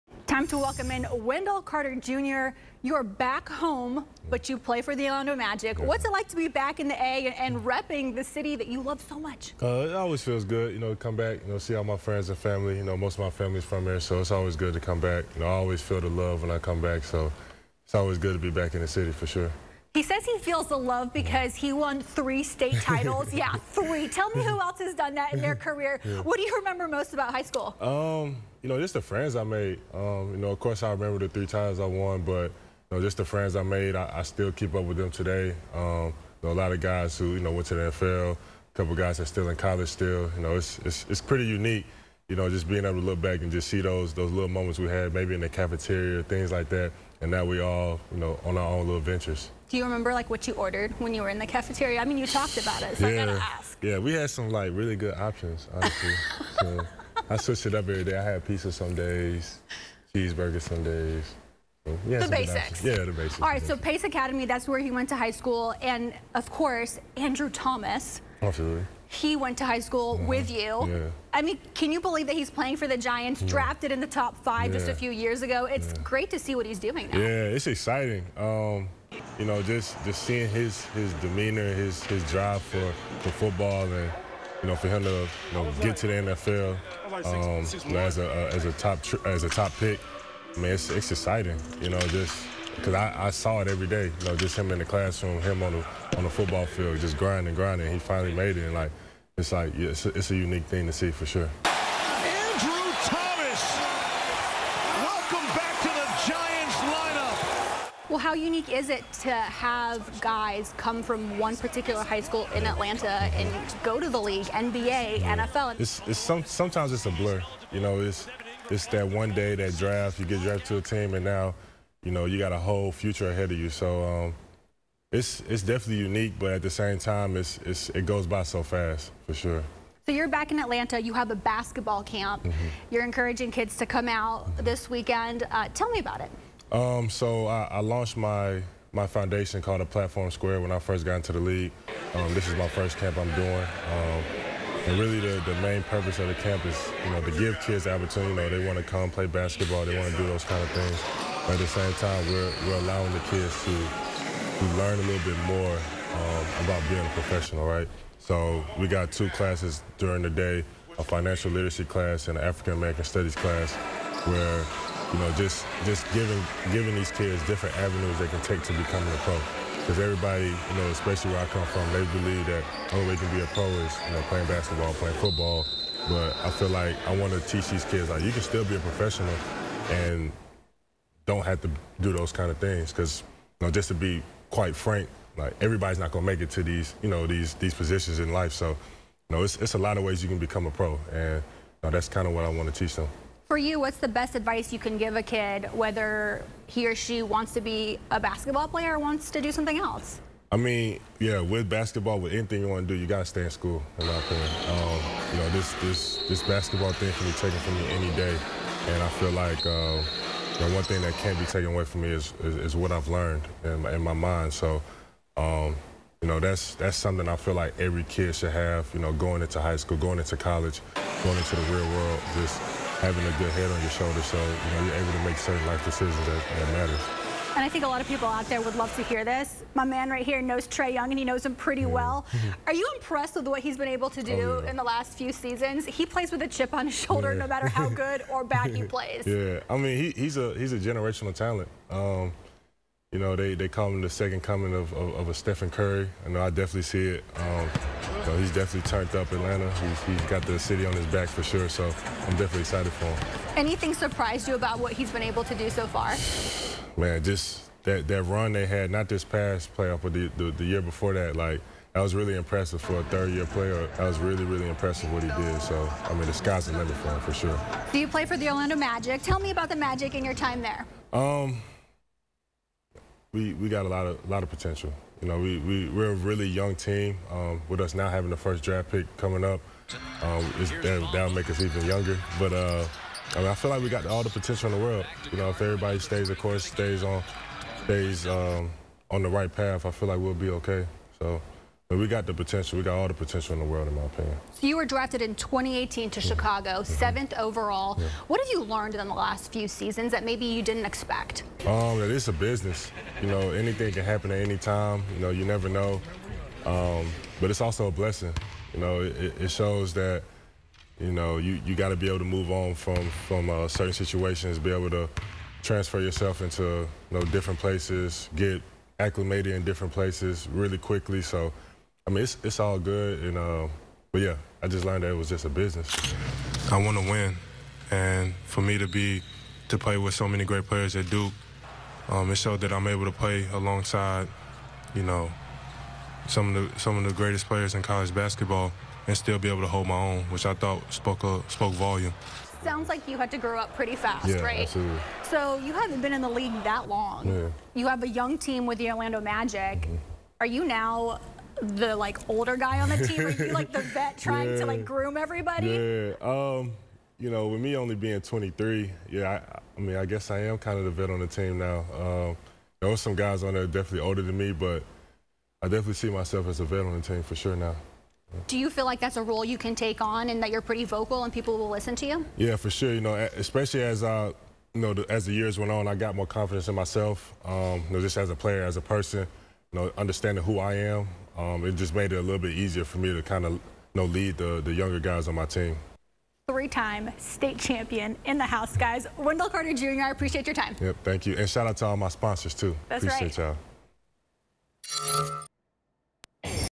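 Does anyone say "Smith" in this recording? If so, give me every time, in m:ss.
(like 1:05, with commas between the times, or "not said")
not said.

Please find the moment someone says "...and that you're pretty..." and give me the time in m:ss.
6:10.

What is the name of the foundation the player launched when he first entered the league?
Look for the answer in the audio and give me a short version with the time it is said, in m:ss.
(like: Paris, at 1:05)
Platform Squared, at 2:19.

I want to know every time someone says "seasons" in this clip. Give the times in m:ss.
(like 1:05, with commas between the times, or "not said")
3:55, 4:59.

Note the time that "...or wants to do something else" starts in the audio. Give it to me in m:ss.
3:18.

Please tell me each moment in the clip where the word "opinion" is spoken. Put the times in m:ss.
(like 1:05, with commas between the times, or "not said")
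3:24, 4:54.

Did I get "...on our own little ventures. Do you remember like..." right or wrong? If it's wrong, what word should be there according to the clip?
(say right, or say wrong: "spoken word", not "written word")
right.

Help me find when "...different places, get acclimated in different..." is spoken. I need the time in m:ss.
5:17.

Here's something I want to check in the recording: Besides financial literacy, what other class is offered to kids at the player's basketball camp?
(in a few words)
African American studies.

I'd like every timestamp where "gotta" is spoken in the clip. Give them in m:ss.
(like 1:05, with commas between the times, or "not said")
0:53, 3:23.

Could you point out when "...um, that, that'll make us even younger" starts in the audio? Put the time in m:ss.
4:40.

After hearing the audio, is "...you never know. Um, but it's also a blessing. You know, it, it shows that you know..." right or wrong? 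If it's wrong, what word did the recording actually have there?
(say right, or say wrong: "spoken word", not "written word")
right.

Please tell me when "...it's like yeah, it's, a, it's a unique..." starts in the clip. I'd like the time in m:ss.
1:39.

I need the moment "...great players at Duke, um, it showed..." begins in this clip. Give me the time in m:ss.
5:30.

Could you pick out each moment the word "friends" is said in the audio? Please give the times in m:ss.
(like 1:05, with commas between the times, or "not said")
0:11, 0:29, 0:33.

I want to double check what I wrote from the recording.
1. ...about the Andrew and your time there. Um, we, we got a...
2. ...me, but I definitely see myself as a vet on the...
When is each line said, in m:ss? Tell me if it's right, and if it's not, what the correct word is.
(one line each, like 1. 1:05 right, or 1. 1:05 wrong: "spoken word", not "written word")
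1. 4:29 wrong: "Magic", not "Andrew"
2. 6:04 right.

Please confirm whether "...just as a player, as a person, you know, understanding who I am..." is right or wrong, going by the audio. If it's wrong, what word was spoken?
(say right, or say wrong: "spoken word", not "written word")
right.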